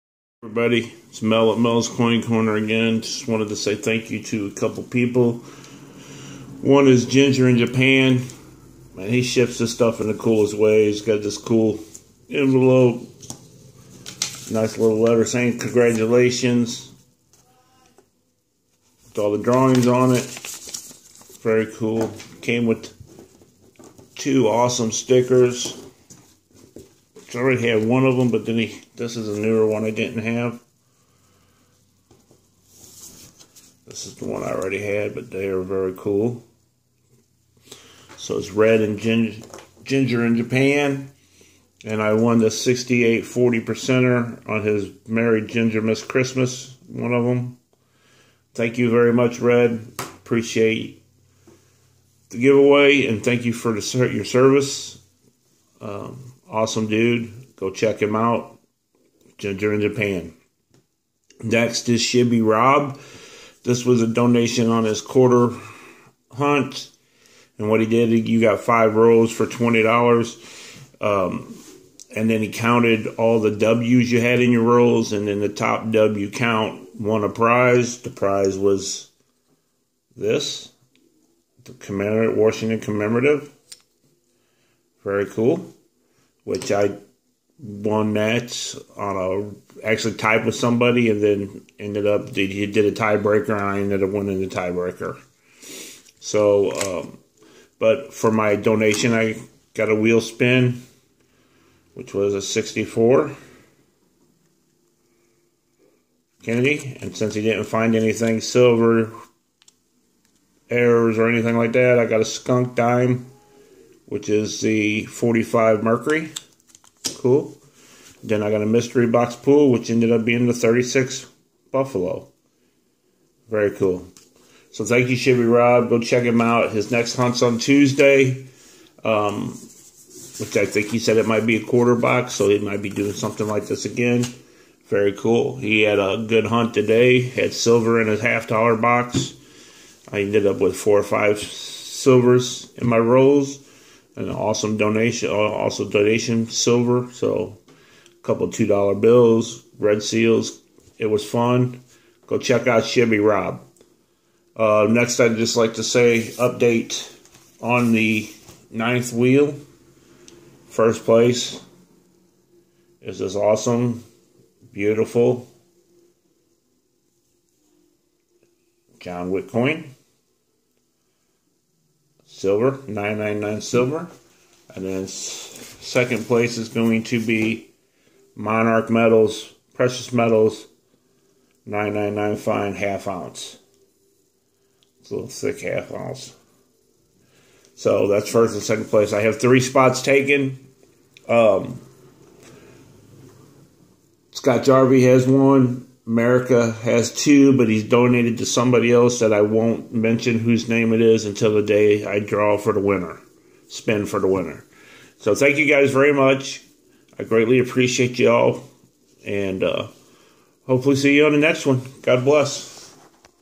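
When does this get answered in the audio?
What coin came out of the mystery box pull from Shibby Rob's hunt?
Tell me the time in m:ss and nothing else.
2:00.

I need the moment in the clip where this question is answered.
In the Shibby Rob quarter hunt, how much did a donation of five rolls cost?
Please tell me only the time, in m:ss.
1:09.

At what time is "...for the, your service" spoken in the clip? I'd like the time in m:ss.
0:53.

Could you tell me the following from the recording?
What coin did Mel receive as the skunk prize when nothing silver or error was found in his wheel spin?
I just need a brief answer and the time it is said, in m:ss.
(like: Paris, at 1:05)
45 Mercury, at 1:55.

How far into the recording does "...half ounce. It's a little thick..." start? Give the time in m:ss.
3:02.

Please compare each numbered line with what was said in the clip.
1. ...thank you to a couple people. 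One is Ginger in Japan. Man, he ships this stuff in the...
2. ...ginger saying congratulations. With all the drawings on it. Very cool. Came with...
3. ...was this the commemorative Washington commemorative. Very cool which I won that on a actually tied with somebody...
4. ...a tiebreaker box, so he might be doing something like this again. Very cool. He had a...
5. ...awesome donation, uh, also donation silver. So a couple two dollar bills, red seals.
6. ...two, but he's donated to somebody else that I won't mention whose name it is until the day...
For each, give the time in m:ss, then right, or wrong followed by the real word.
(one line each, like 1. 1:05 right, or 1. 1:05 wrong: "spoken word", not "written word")
1. 0:03 right
2. 0:14 wrong: "letter", not "ginger"
3. 1:18 right
4. 2:11 wrong: "quarter", not "tiebreaker"
5. 2:24 right
6. 3:17 right.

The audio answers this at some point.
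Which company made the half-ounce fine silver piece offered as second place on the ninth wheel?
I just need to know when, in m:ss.
2:58.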